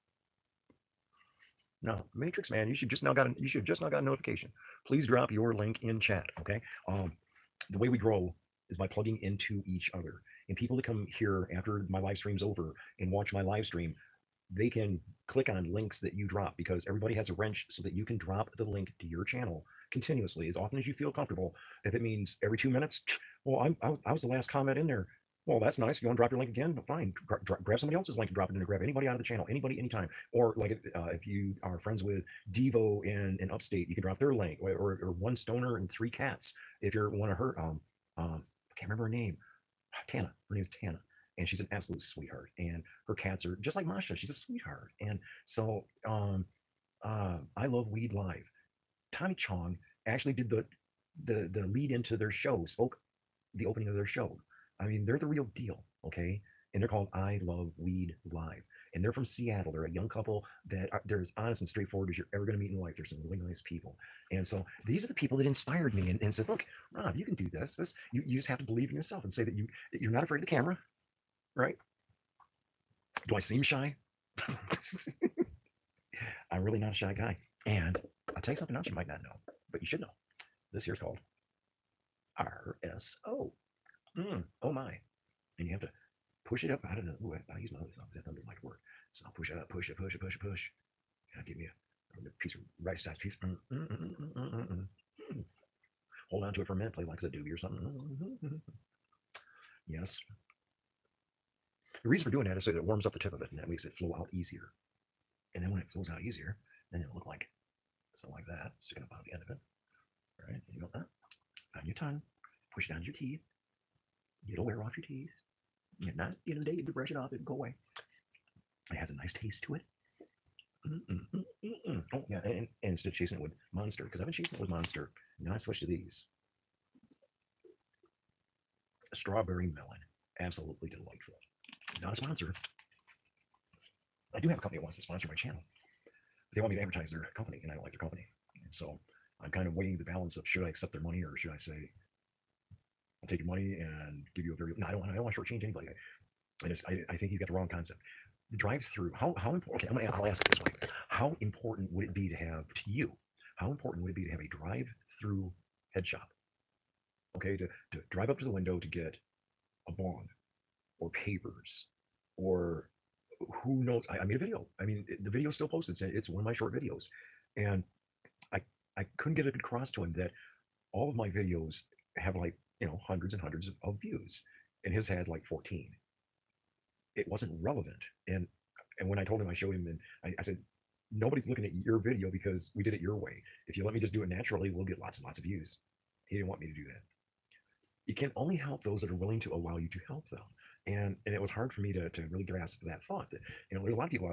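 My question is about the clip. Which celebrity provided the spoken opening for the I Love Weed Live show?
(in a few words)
Tommy Chong.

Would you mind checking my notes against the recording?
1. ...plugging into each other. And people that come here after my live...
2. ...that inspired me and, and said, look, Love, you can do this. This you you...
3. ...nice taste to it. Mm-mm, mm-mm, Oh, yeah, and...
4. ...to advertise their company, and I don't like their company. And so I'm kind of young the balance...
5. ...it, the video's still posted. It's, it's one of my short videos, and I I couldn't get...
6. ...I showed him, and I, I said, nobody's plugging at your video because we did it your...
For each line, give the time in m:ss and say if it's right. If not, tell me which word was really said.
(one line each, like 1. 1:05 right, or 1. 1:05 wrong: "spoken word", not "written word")
1. 0:08 right
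2. 1:05 wrong: "Rob", not "Love"
3. 1:59 right
4. 2:16 wrong: "weighing", not "young"
5. 2:45 right
6. 2:59 wrong: "looking", not "plugging".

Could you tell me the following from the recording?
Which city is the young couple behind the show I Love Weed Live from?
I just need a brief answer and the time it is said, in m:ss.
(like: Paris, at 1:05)
Seattle, at 0:59.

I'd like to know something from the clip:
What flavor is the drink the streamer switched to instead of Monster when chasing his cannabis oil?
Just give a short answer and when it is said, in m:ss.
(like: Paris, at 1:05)
strawberry melon, at 2:09.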